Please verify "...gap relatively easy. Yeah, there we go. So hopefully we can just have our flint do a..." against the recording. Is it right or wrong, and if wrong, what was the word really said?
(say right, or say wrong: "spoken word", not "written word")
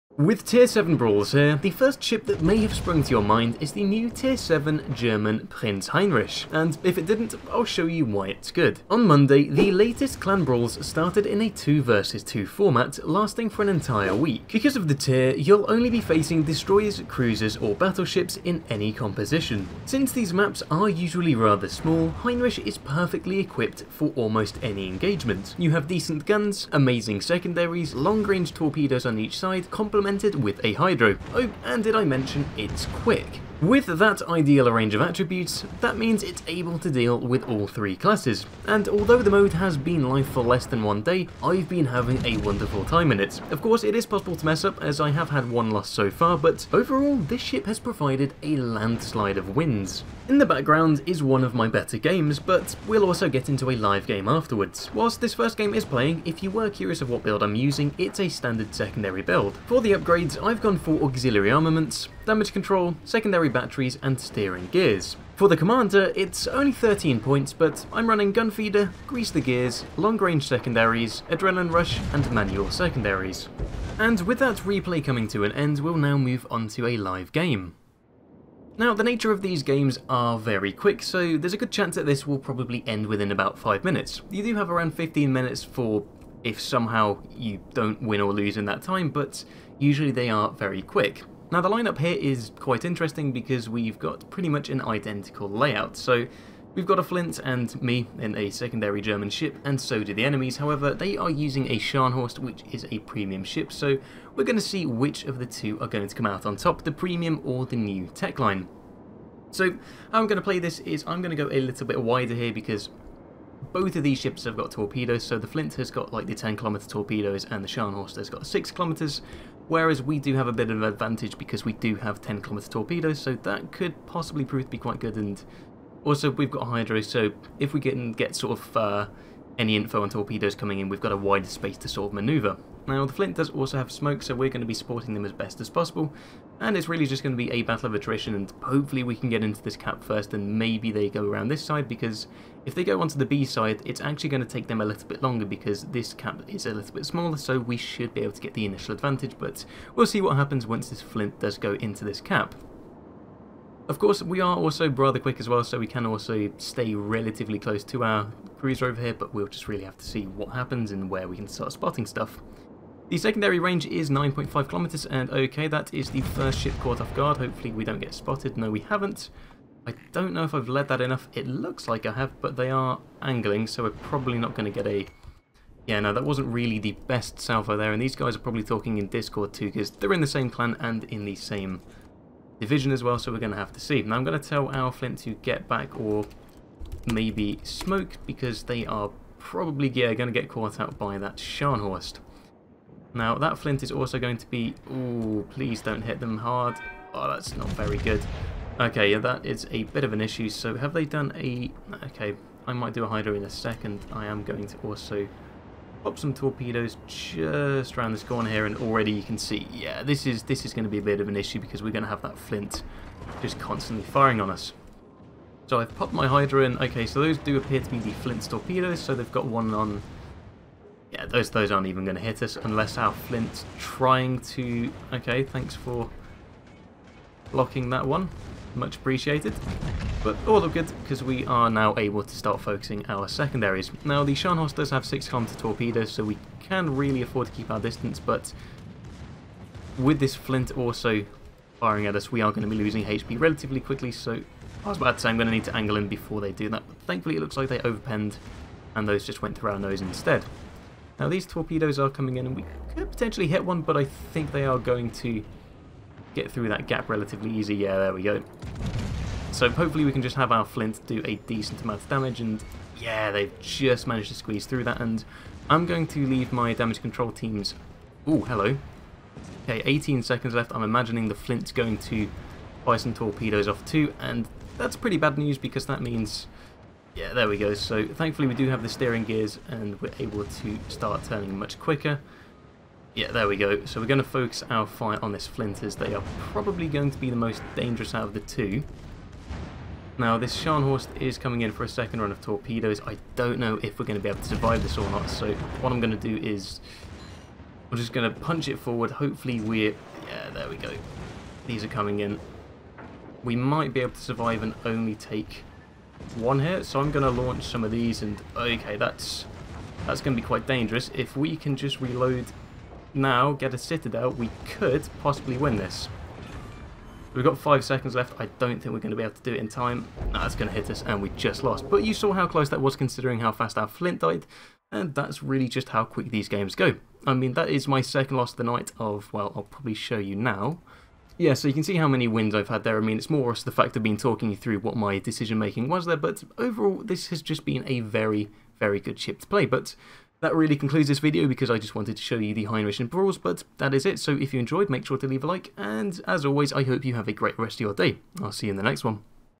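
right.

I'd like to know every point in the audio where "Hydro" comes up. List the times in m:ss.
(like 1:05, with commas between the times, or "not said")
0:30, 2:06, 3:23, 3:36.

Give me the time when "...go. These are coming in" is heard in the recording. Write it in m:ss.
5:00.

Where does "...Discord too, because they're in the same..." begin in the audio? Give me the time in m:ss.
2:59.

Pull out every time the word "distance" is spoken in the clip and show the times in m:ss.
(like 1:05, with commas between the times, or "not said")
3:57.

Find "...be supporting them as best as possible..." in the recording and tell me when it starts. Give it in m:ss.
2:14.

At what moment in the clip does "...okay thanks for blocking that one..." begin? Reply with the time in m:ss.
3:45.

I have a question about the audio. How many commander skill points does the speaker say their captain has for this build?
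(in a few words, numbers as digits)
13.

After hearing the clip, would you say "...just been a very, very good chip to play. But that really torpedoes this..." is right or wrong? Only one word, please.
wrong.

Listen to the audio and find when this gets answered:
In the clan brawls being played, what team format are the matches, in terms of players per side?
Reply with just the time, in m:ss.
0:11.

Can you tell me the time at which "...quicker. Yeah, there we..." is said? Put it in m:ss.
4:41.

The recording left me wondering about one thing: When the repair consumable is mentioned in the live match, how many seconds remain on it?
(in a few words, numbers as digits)
18.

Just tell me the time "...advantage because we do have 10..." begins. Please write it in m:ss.
2:00.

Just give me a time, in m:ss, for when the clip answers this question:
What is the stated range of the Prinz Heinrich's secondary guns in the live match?
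2:44.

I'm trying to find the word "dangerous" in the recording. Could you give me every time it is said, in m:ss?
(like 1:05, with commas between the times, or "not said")
4:47, 5:10.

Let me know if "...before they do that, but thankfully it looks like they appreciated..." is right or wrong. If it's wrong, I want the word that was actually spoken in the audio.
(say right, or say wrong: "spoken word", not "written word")
wrong: "overpenned", not "appreciated".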